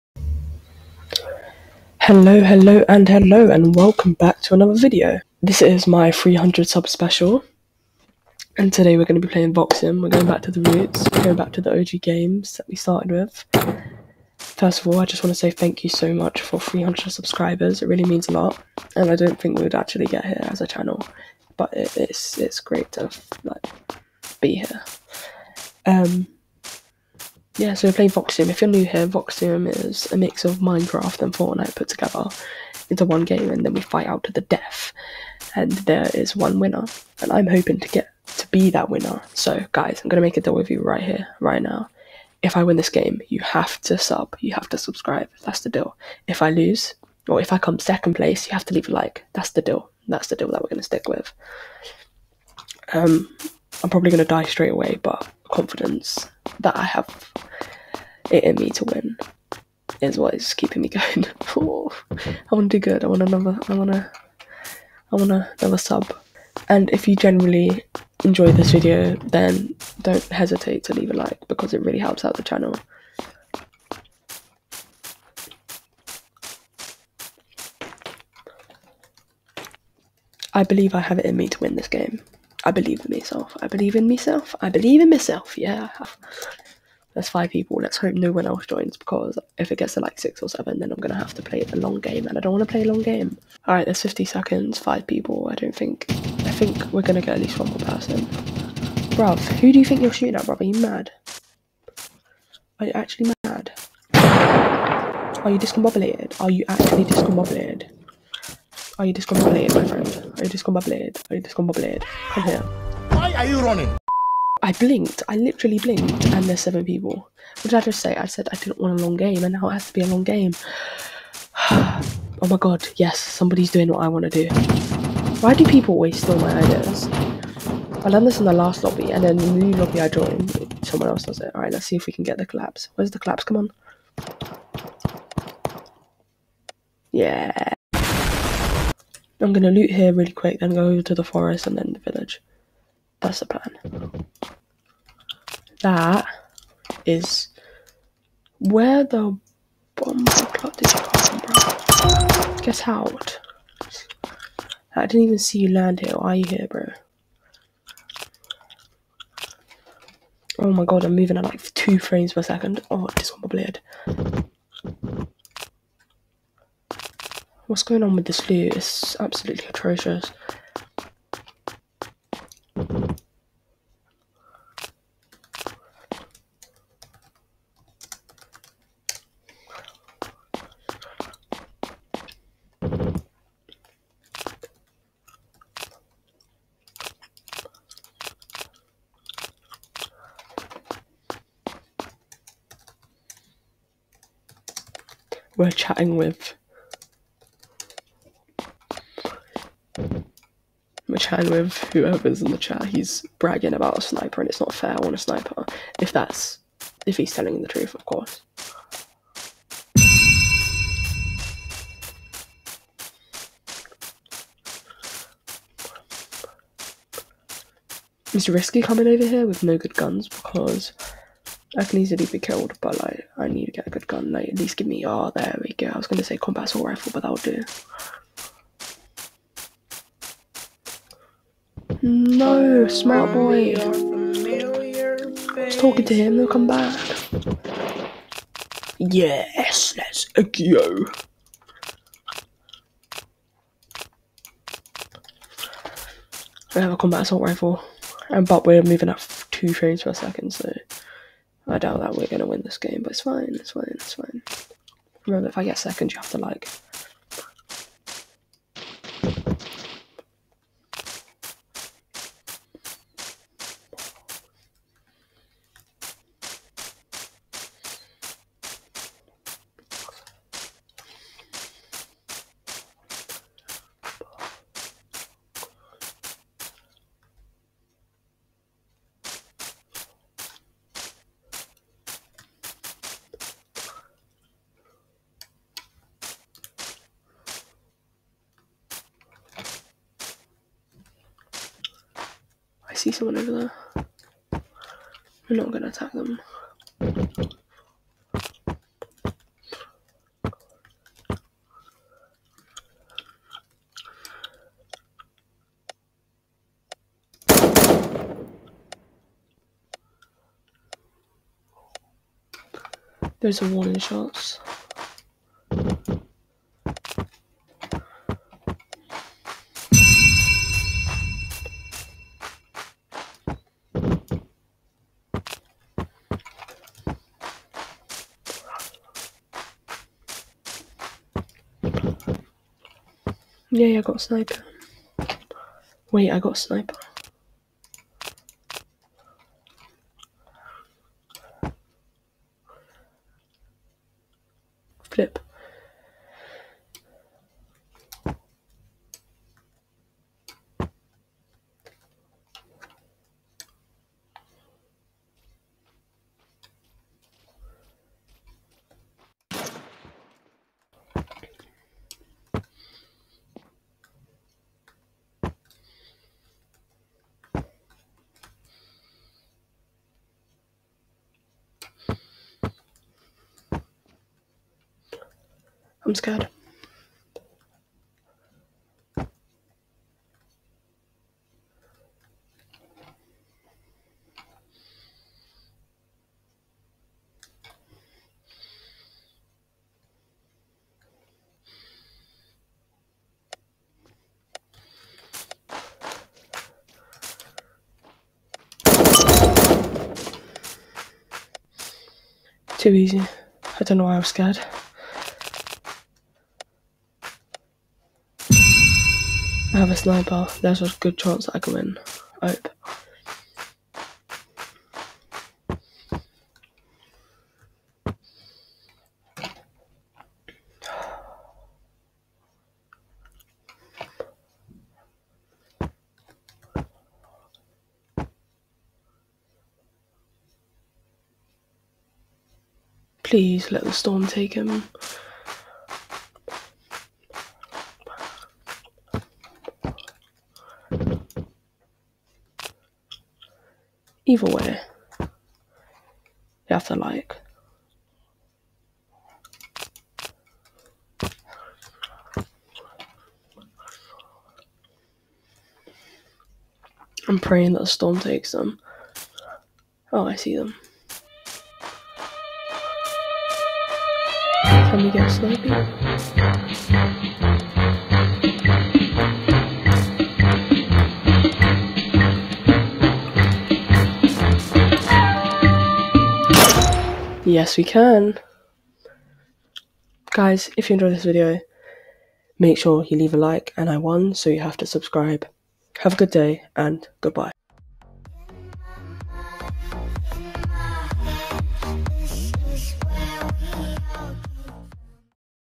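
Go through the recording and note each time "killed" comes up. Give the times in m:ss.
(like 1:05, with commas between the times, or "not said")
3:42.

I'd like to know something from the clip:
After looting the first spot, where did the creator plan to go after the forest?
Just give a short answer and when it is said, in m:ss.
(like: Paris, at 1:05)
The village, at 2:21.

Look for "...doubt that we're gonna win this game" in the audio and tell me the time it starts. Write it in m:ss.
4:11.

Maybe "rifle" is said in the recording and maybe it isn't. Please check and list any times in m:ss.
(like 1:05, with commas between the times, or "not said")
3:46, 4:07.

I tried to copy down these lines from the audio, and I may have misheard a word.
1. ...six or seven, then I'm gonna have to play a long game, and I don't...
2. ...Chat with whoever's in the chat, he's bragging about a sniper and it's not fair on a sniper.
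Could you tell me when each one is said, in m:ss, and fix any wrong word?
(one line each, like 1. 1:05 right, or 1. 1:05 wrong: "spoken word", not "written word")
1. 1:30 right
2. 3:21 right.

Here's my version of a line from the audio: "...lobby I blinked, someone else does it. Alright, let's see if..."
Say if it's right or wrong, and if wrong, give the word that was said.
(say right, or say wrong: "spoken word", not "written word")
wrong: "joined", not "blinked".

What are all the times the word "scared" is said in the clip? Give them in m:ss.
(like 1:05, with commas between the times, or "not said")
6:16, 6:44.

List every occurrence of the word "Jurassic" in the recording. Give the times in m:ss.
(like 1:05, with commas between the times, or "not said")
not said.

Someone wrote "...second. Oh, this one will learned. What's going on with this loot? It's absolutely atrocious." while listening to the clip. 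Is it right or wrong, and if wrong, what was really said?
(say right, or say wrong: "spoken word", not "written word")
wrong: "bleed", not "learned".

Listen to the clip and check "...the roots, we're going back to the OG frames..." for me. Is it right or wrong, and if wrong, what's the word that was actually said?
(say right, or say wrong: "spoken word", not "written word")
wrong: "games", not "frames".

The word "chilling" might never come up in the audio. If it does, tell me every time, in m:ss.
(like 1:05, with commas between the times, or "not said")
not said.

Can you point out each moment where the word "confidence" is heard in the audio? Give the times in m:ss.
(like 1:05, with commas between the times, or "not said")
0:55.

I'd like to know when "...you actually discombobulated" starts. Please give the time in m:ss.
1:46.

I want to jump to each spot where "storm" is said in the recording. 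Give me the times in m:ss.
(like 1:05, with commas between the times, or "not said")
7:13, 7:37.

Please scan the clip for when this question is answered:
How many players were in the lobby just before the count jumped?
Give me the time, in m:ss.
1:56.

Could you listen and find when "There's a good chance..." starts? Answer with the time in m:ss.
6:50.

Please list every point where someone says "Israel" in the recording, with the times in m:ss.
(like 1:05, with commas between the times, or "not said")
not said.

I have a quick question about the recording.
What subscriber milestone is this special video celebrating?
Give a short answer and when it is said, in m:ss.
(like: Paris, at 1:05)
300, at 0:06.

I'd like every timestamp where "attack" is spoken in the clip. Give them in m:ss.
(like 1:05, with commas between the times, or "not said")
4:55.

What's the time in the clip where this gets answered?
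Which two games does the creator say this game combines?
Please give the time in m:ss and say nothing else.
0:30.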